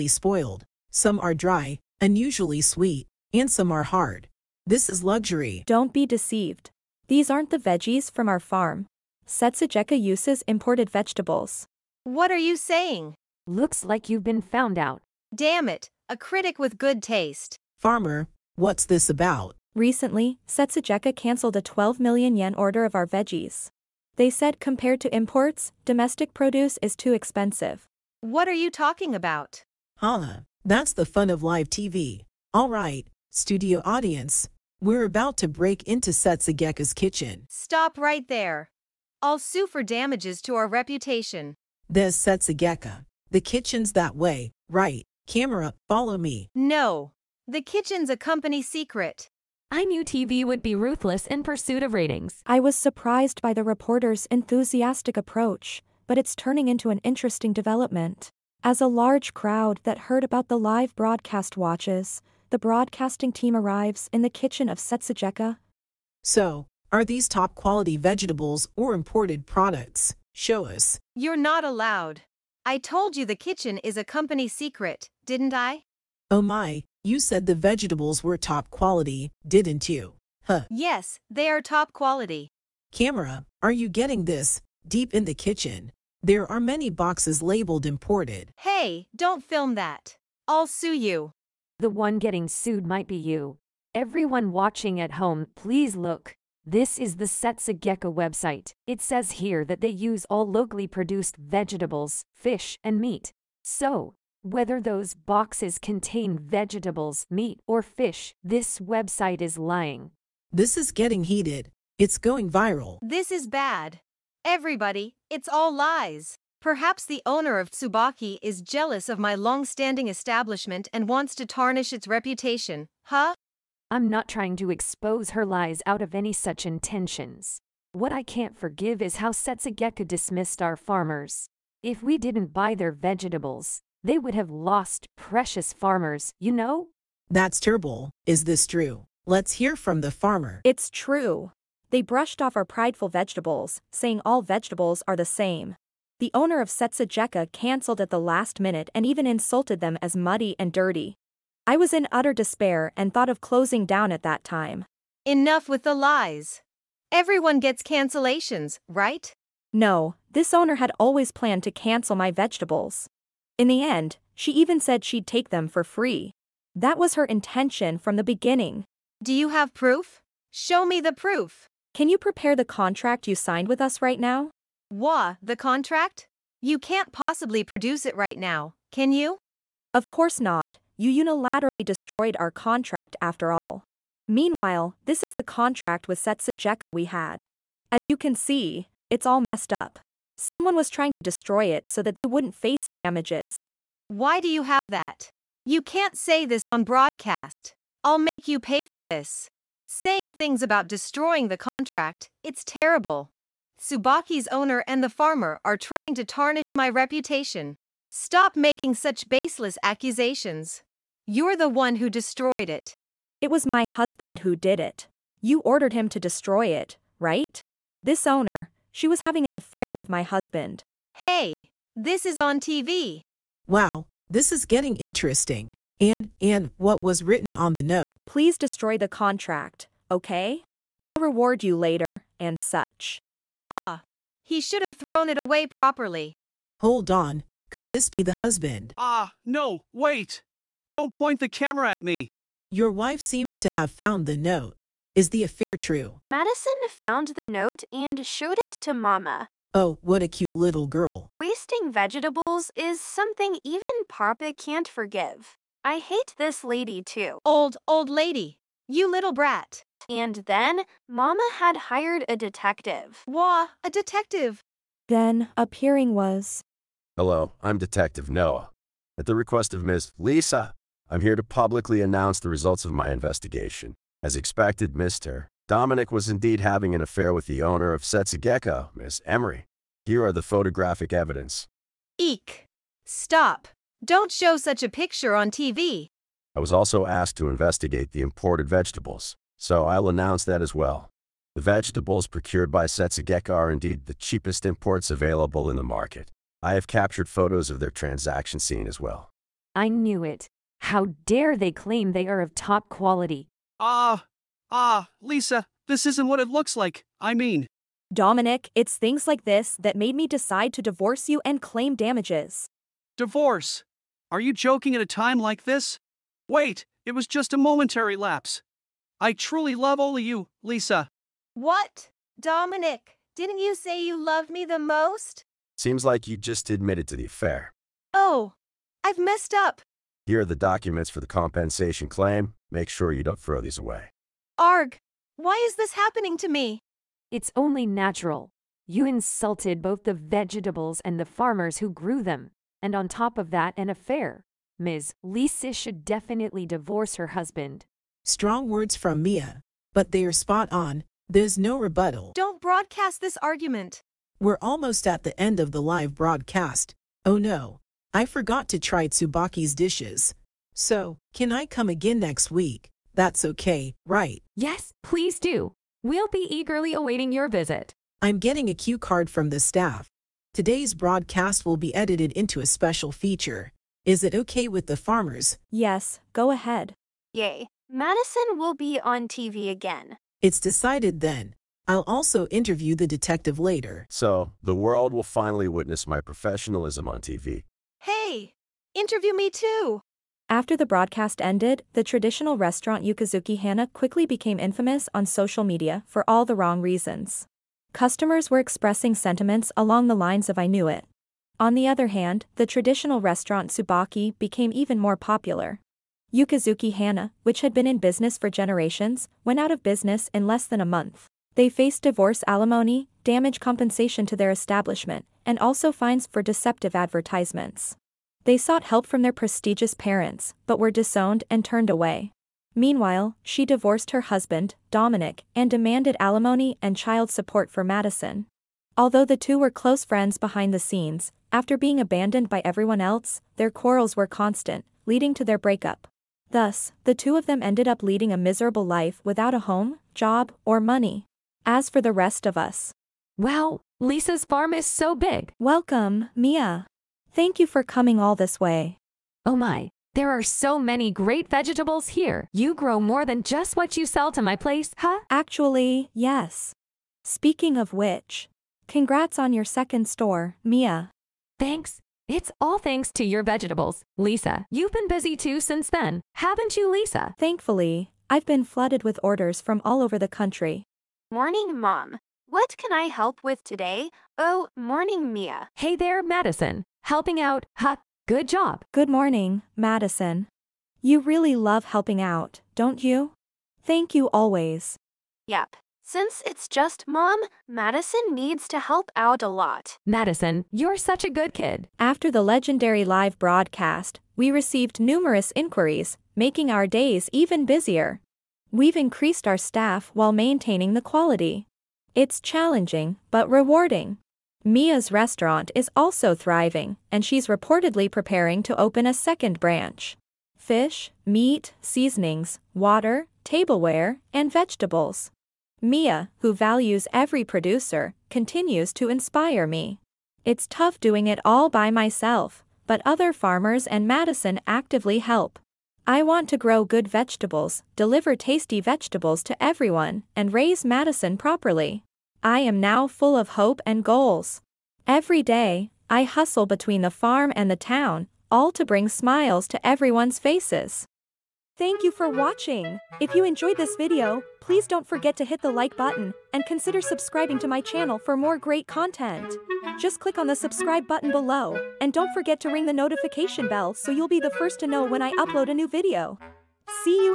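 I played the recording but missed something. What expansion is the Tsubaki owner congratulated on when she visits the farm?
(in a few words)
second store.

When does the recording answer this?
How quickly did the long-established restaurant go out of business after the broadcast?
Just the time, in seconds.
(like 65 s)
410 s.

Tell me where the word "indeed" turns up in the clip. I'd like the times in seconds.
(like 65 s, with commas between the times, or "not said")
276 s, 293 s.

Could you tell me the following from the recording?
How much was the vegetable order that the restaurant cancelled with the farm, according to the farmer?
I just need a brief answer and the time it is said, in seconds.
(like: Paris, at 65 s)
12 million yen, at 21 s.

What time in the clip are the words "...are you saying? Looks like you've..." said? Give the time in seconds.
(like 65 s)
12 s.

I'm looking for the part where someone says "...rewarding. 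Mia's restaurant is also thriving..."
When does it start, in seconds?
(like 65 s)
503 s.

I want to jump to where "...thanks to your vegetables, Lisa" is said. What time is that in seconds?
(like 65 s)
462 s.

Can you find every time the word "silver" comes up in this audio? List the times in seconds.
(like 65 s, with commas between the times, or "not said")
not said.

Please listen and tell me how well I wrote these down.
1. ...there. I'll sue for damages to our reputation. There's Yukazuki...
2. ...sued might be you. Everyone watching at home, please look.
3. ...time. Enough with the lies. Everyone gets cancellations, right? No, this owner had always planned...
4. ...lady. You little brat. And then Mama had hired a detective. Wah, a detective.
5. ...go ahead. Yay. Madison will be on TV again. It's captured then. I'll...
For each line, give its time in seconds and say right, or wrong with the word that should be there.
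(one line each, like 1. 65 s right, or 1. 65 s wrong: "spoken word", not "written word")
1. 38 s wrong: "Setsugeka", not "Yukazuki"
2. 92 s right
3. 154 s right
4. 258 s right
5. 376 s wrong: "decided", not "captured".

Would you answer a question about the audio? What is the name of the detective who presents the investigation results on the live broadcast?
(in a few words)
Noah.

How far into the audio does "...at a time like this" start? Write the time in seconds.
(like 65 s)
314 s.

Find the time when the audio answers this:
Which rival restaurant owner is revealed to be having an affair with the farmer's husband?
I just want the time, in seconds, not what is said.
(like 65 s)
279 s.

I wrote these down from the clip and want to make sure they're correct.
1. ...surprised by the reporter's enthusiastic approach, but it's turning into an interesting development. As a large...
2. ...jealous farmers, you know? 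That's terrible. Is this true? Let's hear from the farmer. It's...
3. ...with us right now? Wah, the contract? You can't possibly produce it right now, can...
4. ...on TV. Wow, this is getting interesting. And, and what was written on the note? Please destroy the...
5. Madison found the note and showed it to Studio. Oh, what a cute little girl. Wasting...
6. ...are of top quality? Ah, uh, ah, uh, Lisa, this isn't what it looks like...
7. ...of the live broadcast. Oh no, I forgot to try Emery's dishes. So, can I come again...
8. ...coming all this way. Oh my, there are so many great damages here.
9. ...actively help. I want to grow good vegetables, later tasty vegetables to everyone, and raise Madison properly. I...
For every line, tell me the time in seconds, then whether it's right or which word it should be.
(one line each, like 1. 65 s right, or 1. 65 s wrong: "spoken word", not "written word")
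1. 52 s right
2. 135 s wrong: "precious", not "jealous"
3. 173 s right
4. 222 s right
5. 246 s wrong: "Mama", not "Studio"
6. 302 s right
7. 355 s wrong: "Tsubaki", not "Emery"
8. 447 s wrong: "vegetables", not "damages"
9. 524 s wrong: "deliver", not "later".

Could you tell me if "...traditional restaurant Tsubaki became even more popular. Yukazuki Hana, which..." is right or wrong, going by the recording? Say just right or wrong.
right.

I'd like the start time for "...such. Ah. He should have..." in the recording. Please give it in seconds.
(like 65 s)
232 s.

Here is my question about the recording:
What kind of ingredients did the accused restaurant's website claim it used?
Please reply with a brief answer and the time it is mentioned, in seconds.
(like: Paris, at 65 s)
locally produced, at 100 s.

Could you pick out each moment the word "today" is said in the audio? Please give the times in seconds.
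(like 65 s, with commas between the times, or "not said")
370 s, 473 s.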